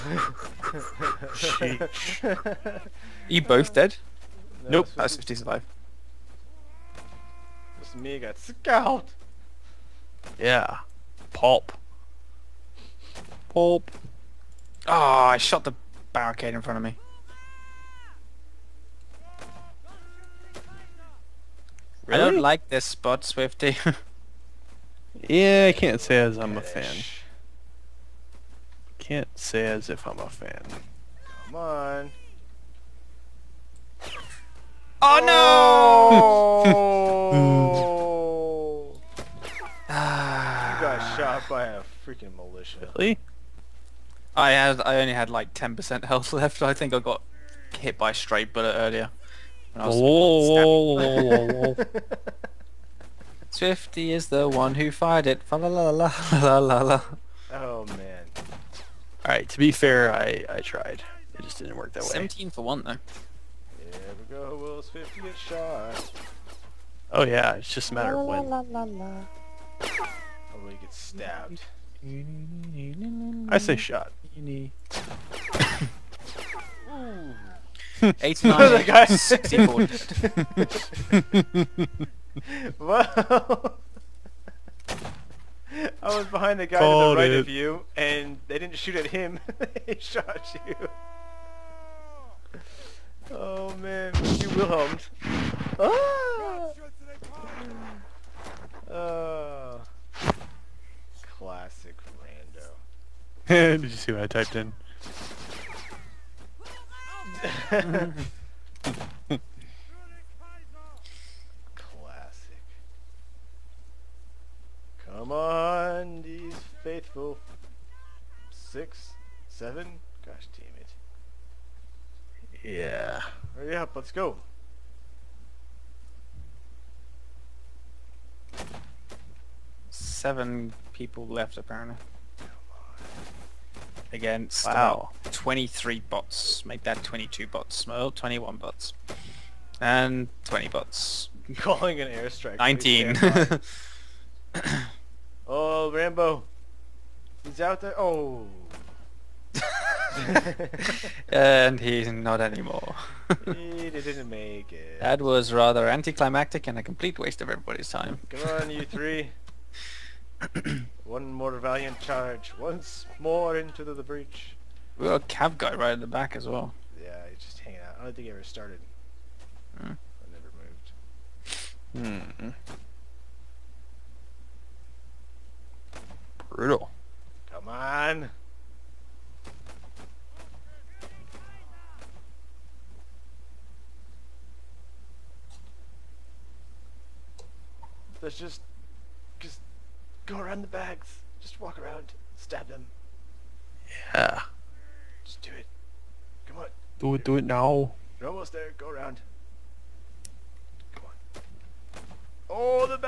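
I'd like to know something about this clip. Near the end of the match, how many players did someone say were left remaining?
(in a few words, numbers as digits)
7.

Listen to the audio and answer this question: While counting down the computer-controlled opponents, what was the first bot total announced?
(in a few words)
23.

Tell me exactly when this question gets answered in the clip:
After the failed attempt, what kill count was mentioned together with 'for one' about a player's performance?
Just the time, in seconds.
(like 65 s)
62 s.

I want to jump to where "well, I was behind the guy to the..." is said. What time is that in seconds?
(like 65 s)
82 s.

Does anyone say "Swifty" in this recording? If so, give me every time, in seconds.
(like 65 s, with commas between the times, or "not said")
23 s, 53 s.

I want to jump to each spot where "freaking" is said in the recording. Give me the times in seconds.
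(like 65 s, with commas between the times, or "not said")
42 s.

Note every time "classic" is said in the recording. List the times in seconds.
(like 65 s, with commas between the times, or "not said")
101 s, 107 s.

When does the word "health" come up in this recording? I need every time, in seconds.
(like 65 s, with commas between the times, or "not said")
46 s.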